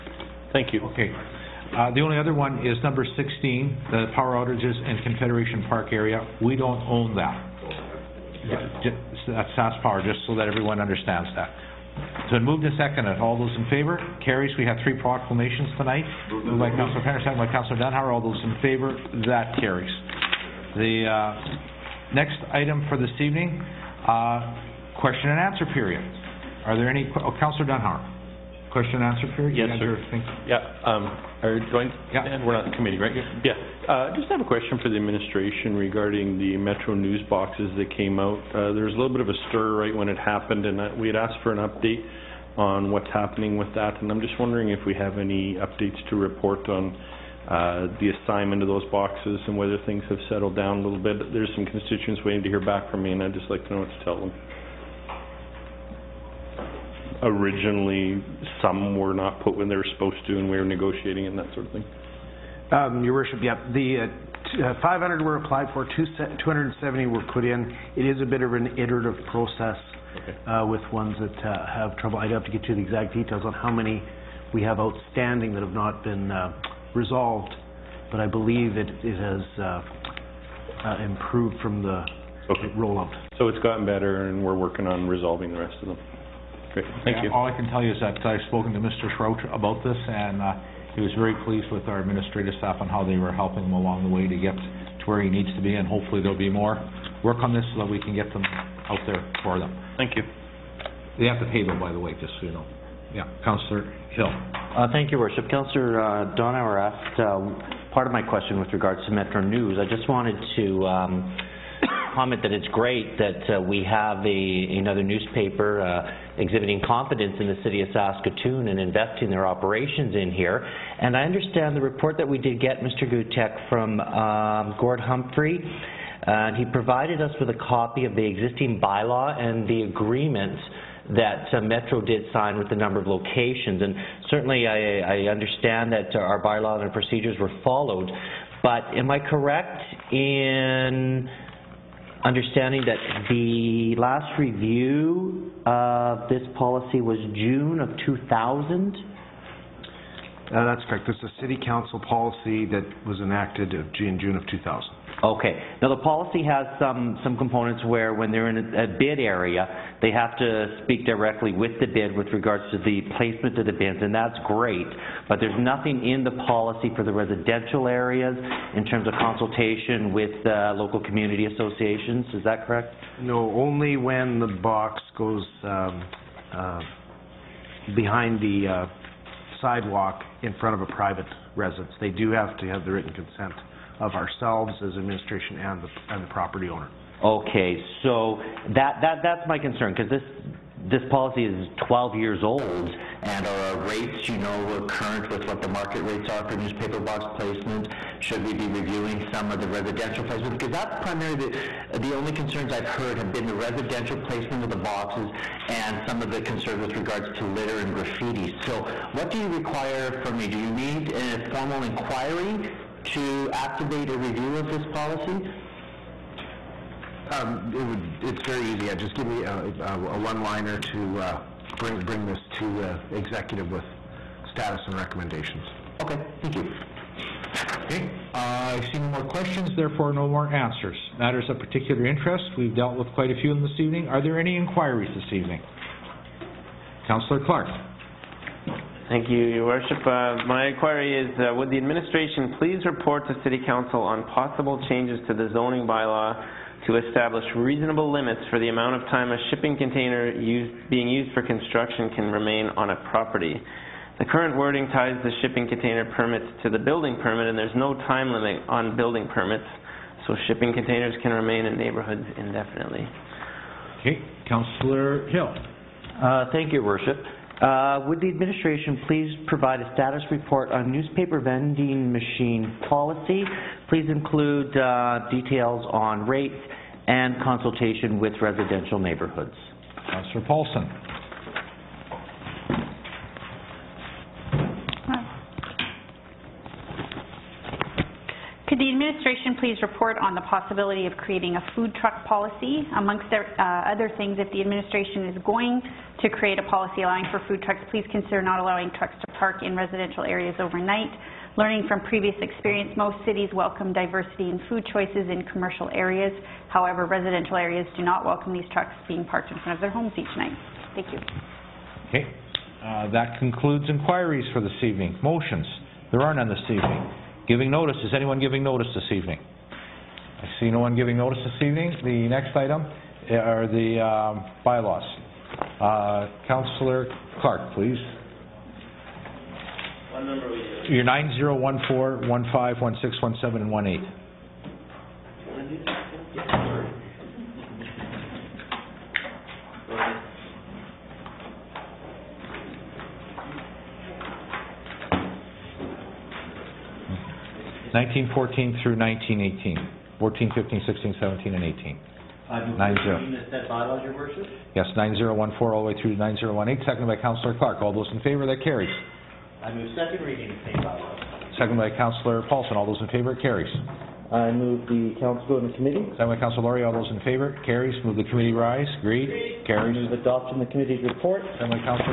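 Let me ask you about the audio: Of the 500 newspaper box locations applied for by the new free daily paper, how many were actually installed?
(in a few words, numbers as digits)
270.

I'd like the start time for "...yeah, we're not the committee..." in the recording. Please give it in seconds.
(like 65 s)
32 s.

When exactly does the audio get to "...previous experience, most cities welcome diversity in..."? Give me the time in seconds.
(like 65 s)
302 s.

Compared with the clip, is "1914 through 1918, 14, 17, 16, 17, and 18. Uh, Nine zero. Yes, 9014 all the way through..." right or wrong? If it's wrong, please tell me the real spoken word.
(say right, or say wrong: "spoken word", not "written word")
wrong: "15", not "17".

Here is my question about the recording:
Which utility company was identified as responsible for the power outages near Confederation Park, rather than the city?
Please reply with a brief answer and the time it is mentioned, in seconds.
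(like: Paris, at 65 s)
SAS Power, at 9 s.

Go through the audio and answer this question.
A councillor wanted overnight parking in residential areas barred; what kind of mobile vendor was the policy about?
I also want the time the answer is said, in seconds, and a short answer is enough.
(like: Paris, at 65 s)
food trucks, at 291 s.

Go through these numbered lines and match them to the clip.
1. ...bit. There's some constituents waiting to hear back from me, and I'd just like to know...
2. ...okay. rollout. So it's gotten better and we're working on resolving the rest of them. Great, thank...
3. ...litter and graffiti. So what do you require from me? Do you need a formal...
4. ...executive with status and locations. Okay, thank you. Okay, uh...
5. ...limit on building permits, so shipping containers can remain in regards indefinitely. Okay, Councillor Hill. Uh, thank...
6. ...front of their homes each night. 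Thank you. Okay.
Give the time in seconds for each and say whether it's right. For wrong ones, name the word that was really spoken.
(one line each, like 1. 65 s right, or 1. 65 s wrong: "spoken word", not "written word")
1. 51 s right
2. 82 s right
3. 207 s right
4. 223 s wrong: "recommendations", not "locations"
5. 258 s wrong: "neighborhoods", not "regards"
6. 309 s right.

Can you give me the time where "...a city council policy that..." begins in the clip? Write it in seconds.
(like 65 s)
151 s.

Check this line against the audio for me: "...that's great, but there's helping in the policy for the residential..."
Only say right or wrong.
wrong.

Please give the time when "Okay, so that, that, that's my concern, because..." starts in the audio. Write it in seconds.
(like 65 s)
187 s.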